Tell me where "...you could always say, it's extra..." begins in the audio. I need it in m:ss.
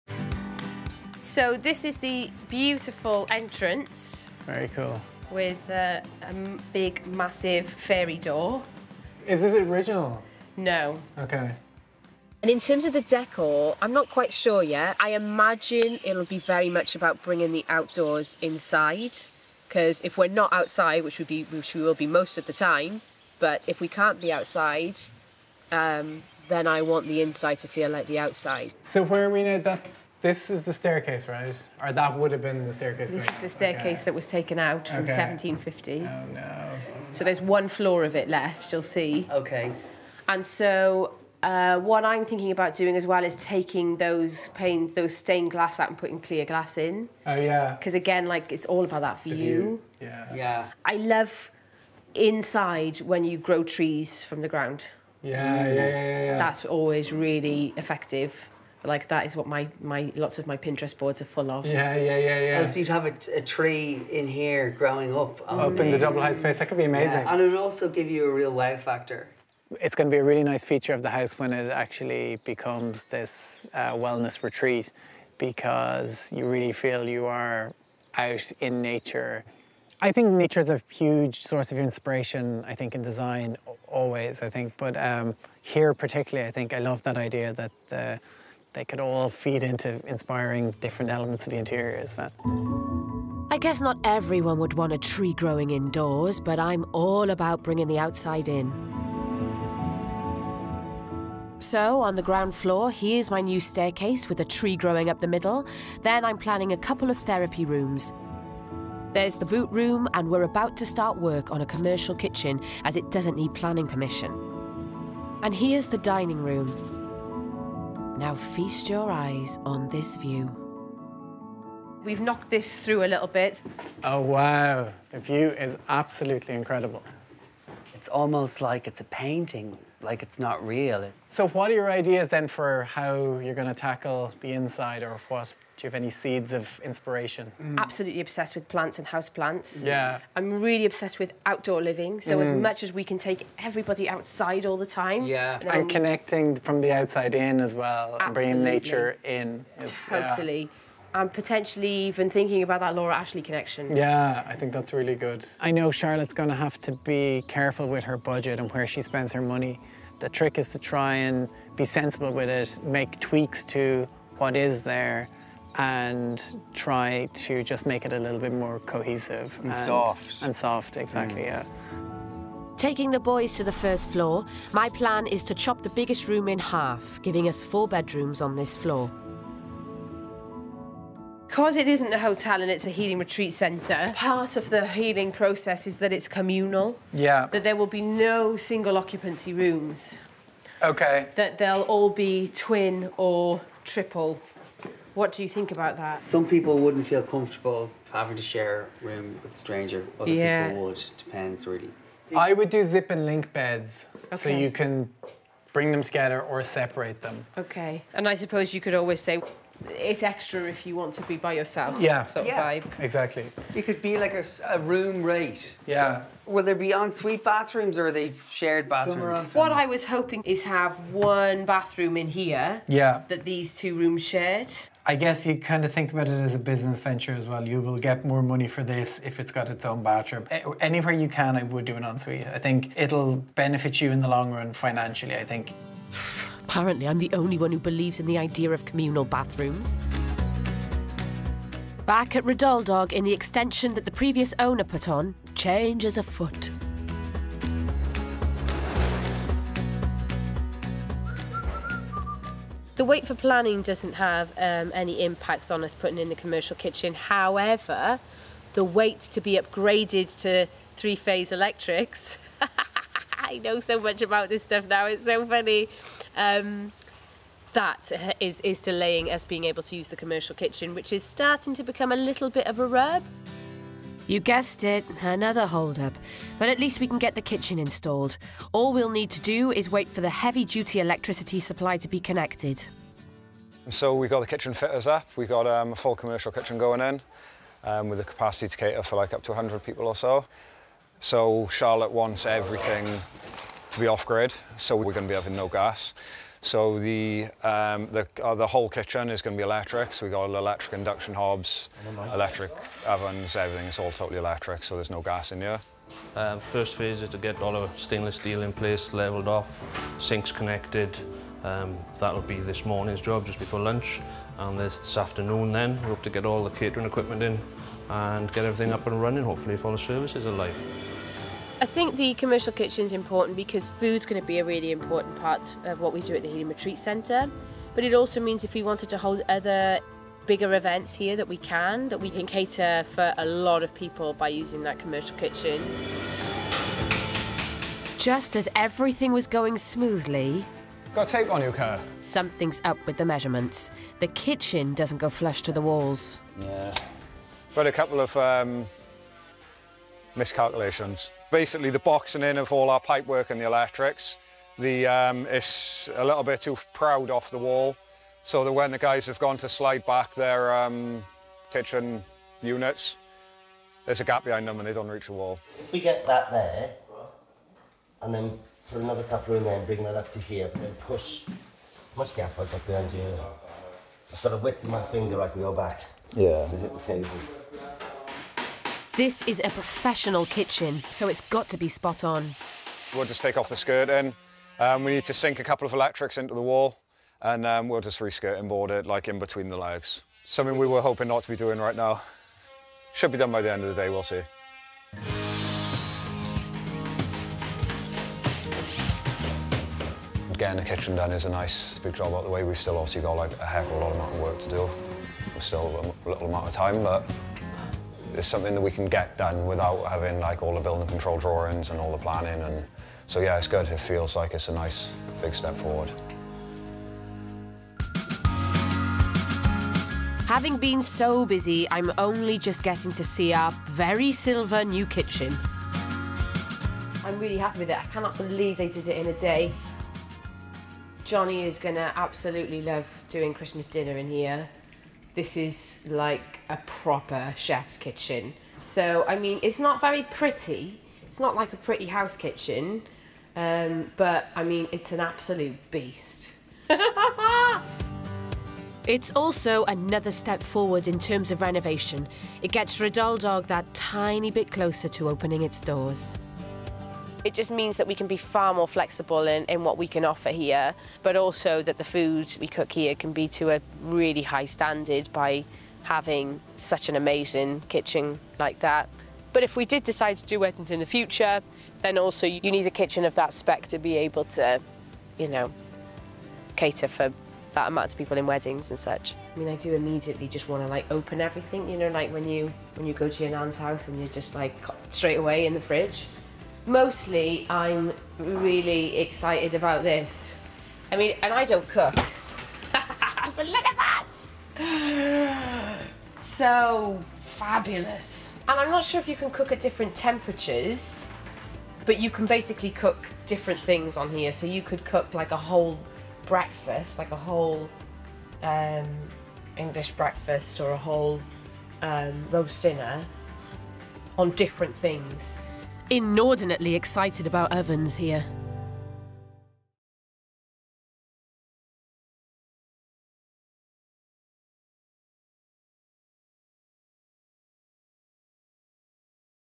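3:28.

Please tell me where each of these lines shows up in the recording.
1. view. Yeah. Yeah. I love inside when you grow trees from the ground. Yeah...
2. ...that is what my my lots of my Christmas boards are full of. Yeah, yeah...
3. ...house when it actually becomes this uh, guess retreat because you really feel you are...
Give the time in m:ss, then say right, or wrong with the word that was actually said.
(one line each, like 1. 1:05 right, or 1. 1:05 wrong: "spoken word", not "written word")
1. 0:49 right
2. 0:59 wrong: "Pinterest", not "Christmas"
3. 1:11 wrong: "wellness", not "guess".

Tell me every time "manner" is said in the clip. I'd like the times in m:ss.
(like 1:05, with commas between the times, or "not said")
not said.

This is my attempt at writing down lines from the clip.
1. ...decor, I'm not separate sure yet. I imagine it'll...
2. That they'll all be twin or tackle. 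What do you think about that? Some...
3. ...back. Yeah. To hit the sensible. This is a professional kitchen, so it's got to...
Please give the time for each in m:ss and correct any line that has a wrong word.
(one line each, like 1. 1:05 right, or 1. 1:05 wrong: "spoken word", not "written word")
1. 0:13 wrong: "quite", not "separate"
2. 3:11 wrong: "triple", not "tackle"
3. 6:15 wrong: "cable", not "sensible".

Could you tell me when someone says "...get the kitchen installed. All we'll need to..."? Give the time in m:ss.
4:37.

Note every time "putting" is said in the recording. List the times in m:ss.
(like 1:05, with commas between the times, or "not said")
0:45, 4:15.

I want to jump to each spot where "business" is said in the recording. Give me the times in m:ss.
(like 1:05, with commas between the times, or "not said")
3:46.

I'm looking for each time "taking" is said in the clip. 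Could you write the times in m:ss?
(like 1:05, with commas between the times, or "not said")
0:43, 2:52.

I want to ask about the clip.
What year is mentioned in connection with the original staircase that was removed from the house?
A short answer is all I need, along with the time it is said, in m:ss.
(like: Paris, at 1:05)
1750, at 0:35.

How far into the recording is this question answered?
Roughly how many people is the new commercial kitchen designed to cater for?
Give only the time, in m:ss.
4:49.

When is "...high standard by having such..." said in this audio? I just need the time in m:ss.
7:44.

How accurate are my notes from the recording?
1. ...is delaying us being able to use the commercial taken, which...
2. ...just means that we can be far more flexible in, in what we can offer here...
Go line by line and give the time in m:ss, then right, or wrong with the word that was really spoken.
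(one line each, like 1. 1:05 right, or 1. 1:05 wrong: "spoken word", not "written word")
1. 4:28 wrong: "kitchen", not "taken"
2. 7:37 right.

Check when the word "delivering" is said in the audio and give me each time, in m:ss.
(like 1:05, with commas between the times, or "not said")
not said.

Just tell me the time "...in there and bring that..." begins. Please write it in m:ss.
6:09.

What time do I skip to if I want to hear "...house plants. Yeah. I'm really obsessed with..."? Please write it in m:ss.
2:19.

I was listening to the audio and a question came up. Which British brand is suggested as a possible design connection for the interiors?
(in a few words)
Laura Ashley.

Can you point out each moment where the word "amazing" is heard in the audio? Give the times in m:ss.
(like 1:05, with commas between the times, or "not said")
1:06, 7:47.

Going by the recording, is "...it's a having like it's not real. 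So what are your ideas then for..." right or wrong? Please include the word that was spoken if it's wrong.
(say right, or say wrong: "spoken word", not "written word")
wrong: "painting", not "having".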